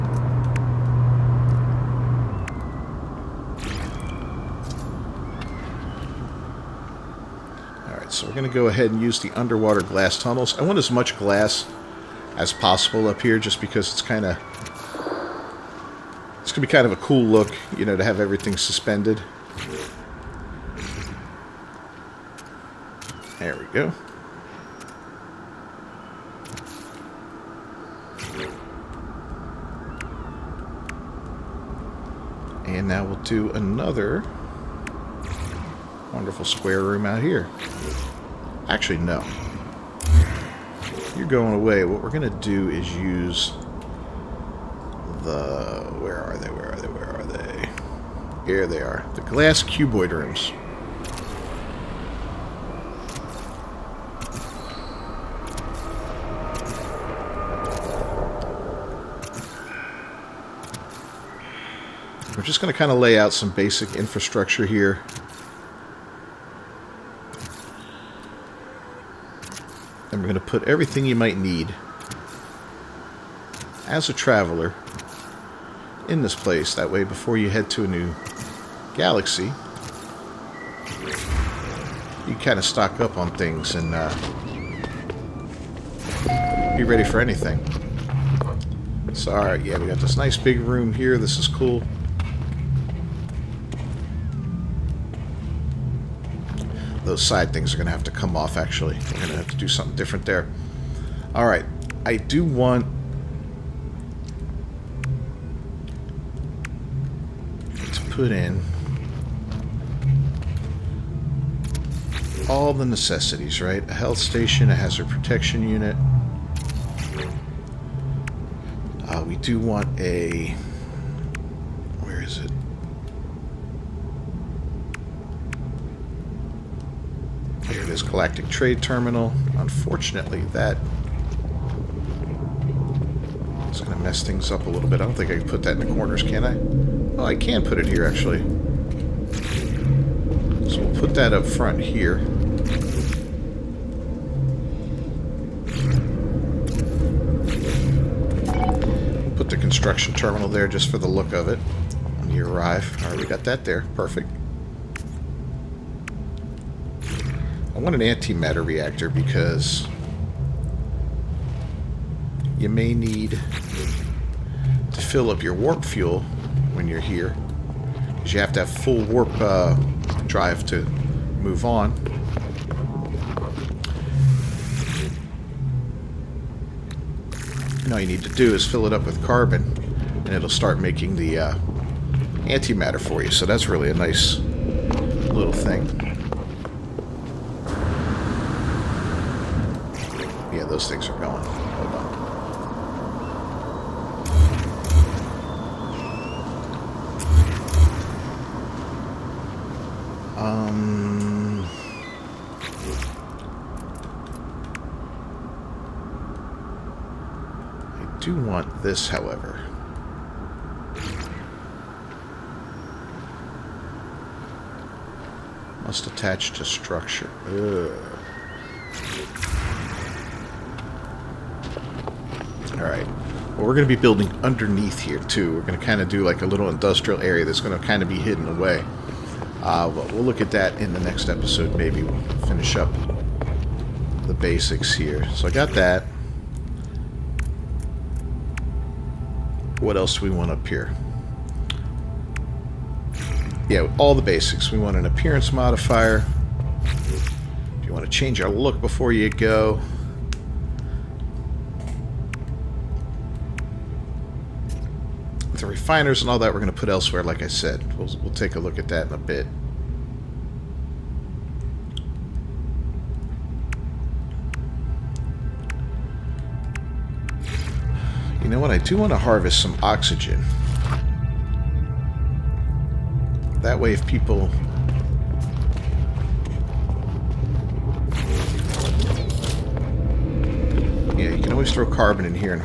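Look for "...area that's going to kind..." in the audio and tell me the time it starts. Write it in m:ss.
3:47.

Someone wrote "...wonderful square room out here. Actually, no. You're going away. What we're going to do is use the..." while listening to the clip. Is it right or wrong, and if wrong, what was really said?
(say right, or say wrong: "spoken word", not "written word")
right.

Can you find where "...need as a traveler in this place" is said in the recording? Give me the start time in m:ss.
1:11.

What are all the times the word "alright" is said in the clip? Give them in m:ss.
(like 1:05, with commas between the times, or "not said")
0:07, 1:29, 1:41.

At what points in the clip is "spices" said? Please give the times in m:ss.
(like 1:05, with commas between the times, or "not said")
not said.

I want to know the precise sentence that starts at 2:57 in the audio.
And all you need to do is fill it up with carbon, and it'll start making the uh, antimatter for you.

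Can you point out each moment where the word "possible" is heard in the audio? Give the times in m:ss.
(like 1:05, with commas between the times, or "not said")
0:12.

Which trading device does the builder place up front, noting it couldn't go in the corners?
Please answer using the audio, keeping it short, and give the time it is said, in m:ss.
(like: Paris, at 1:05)
Galactic Trade Terminal, at 2:08.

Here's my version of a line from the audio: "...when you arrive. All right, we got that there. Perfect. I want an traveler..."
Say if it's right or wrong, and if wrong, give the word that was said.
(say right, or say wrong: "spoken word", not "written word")
wrong: "antimatter", not "traveler".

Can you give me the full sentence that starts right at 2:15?
I don't think I can put that in the corners, can I?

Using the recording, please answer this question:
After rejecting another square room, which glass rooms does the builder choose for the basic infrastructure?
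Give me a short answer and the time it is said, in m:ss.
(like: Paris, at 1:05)
Glass cuboid rooms, at 0:49.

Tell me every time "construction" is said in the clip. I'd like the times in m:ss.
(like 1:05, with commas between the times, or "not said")
2:29.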